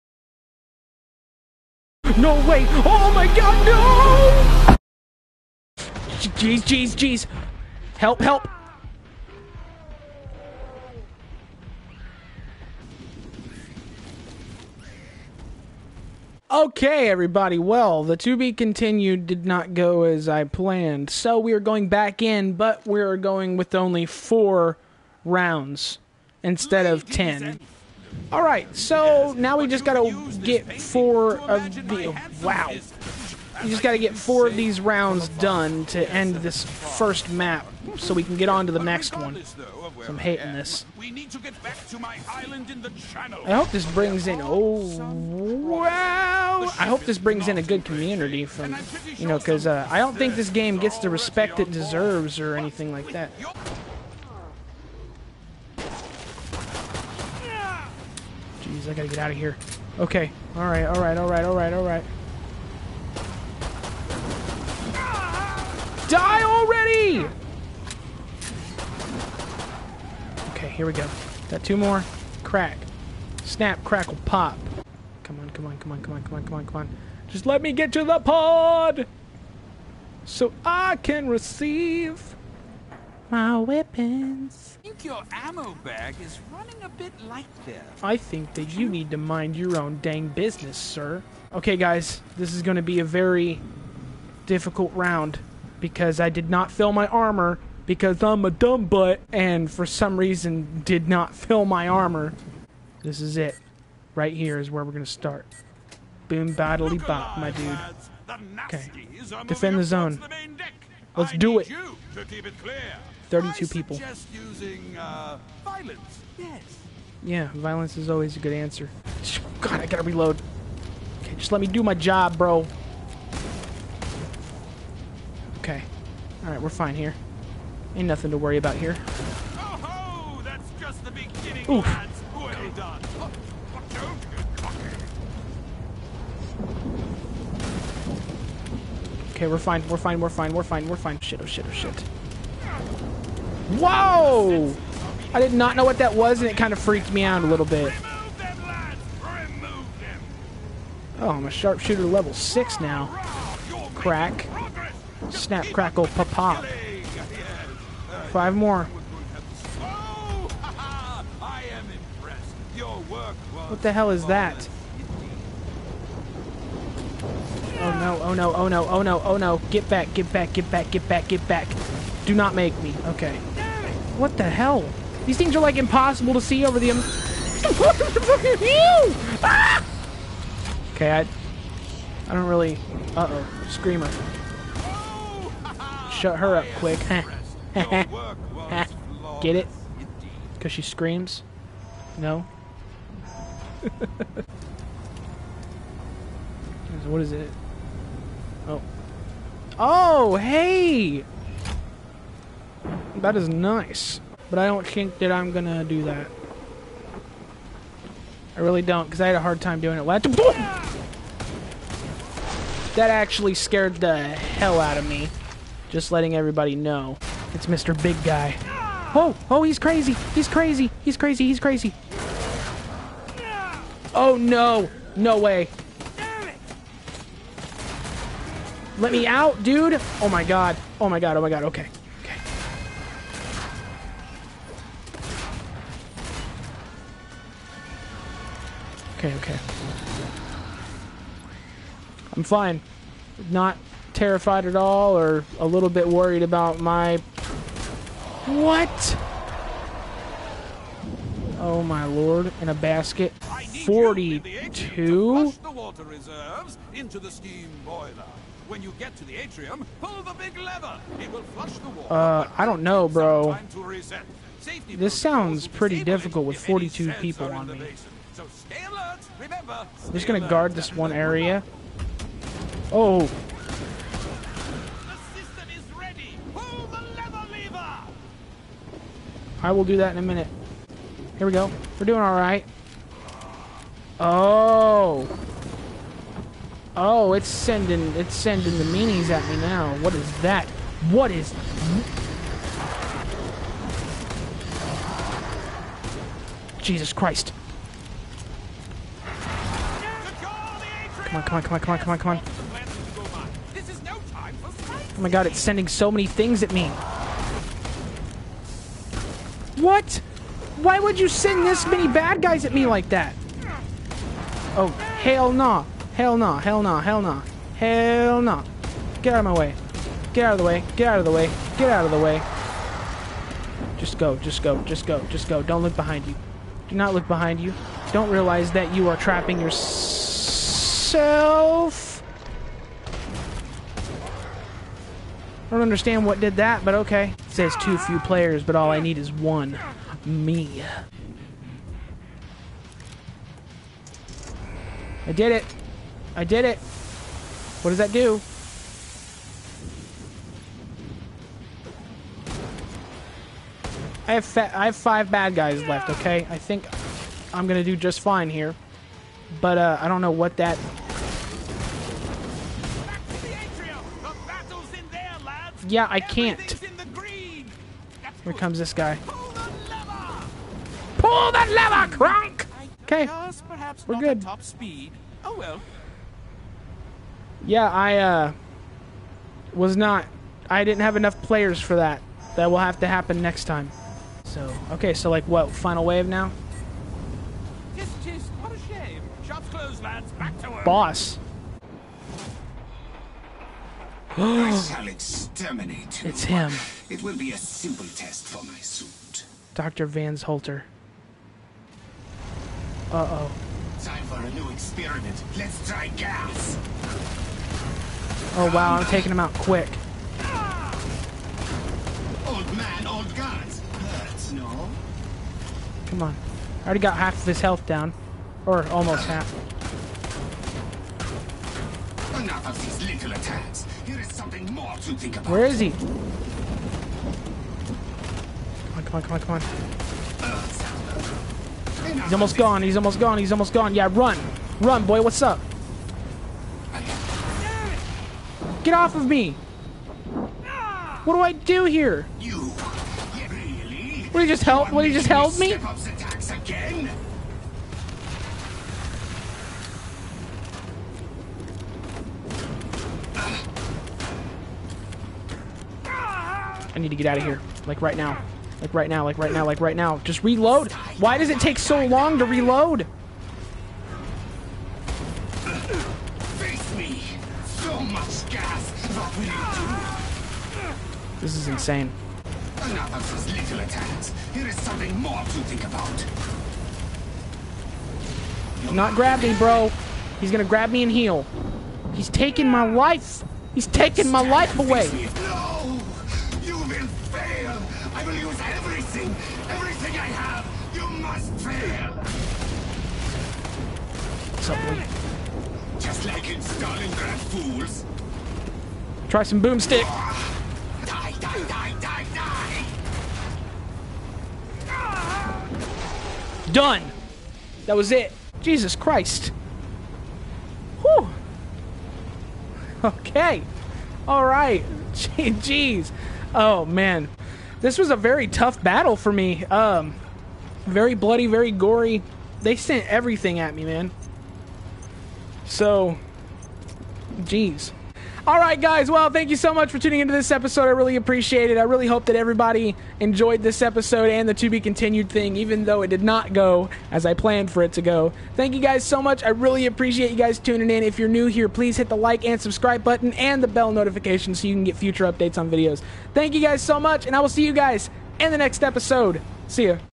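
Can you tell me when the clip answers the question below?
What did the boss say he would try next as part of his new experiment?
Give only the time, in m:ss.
6:46.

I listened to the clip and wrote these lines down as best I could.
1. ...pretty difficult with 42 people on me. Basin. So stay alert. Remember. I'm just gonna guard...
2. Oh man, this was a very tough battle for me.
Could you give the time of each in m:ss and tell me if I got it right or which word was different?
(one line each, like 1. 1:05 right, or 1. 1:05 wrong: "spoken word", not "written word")
1. 4:25 right
2. 8:36 right.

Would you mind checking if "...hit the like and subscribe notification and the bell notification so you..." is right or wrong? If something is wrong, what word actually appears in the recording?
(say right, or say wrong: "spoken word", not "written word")
wrong: "button", not "notification".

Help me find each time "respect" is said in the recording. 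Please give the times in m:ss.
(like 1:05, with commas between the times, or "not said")
0:51.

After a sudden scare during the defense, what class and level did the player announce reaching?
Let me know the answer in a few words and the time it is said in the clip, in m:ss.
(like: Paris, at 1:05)
Sharpshooter level 6, at 2:31.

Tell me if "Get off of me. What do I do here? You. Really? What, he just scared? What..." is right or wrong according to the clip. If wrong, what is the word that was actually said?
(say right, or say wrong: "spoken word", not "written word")
wrong: "helped", not "scared".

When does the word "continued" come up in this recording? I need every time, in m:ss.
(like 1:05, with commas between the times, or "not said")
0:18, 8:54.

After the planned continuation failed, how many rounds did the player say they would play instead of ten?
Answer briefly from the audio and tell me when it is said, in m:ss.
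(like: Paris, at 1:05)
4, at 0:24.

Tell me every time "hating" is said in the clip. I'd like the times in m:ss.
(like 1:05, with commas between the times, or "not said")
0:40.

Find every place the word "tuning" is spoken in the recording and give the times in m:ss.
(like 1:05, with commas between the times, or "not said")
8:49, 9:00.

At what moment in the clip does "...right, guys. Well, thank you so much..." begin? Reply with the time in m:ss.
8:48.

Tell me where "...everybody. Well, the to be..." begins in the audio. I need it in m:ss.
0:17.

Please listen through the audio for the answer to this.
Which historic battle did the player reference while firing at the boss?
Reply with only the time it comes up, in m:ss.
8:16.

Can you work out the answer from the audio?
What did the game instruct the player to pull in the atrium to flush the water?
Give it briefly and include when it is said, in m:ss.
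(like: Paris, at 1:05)
The big lever, at 4:20.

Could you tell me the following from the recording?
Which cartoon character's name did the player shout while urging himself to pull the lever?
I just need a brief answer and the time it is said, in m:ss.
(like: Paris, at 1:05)
Kronk, at 6:12.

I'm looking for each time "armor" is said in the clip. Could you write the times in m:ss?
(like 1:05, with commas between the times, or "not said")
1:37, 1:41.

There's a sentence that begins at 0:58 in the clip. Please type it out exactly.
I gotta get out of here.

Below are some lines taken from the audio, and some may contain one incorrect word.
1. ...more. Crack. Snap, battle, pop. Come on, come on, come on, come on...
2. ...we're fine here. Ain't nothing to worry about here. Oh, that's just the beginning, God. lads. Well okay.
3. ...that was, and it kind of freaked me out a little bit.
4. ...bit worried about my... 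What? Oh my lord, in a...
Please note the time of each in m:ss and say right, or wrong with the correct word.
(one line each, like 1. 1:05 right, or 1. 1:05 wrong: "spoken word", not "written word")
1. 1:11 wrong: "crackle", not "battle"
2. 2:06 wrong: "Oof", not "God"
3. 2:25 right
4. 4:05 right.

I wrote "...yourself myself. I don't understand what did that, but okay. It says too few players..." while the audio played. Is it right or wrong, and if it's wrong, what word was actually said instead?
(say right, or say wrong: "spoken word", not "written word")
right.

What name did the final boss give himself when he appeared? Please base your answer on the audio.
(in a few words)
Dr. Vans Holter.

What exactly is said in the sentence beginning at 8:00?
He's gonna grab me and heal.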